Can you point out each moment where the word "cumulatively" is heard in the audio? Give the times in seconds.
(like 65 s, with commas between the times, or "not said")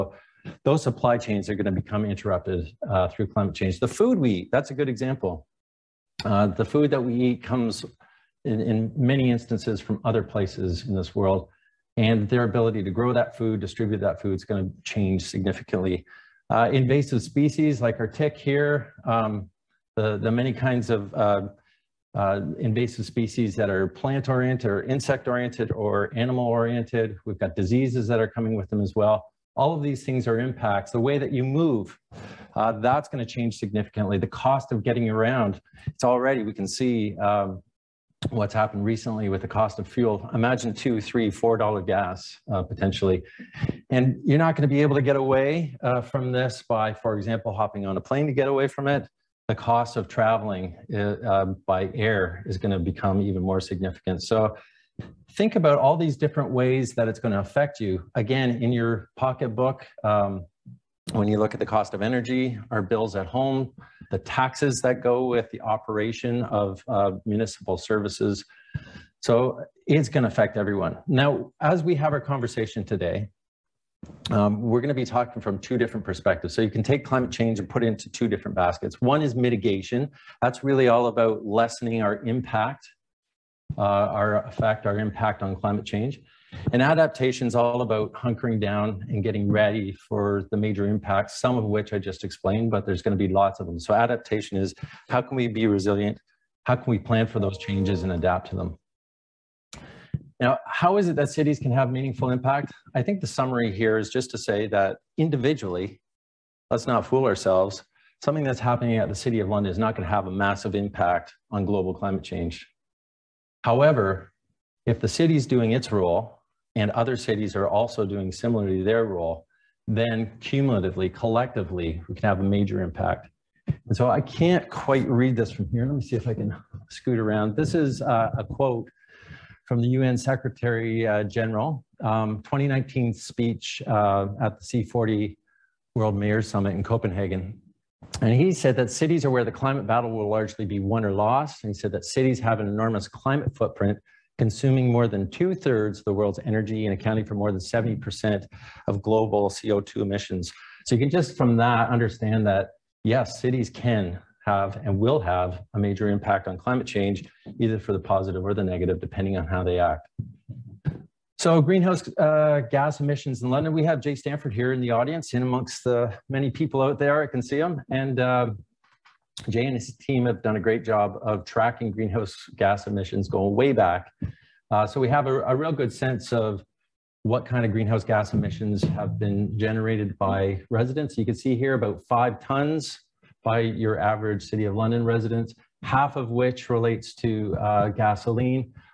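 120 s.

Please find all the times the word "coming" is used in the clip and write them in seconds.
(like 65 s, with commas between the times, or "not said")
28 s.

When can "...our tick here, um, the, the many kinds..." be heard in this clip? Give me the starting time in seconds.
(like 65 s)
18 s.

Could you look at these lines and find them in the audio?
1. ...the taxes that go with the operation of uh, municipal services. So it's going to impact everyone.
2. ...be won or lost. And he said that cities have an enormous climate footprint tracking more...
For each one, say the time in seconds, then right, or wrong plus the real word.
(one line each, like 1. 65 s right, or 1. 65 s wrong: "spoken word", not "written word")
1. 64 s wrong: "affect", not "impact"
2. 140 s wrong: "consuming", not "tracking".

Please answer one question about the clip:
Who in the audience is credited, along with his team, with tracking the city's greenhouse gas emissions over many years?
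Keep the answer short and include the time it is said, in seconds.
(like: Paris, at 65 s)
Jay Stanford, at 164 s.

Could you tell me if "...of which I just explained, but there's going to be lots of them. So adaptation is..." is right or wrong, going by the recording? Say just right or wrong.
right.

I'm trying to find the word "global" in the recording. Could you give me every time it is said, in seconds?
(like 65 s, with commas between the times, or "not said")
111 s, 149 s.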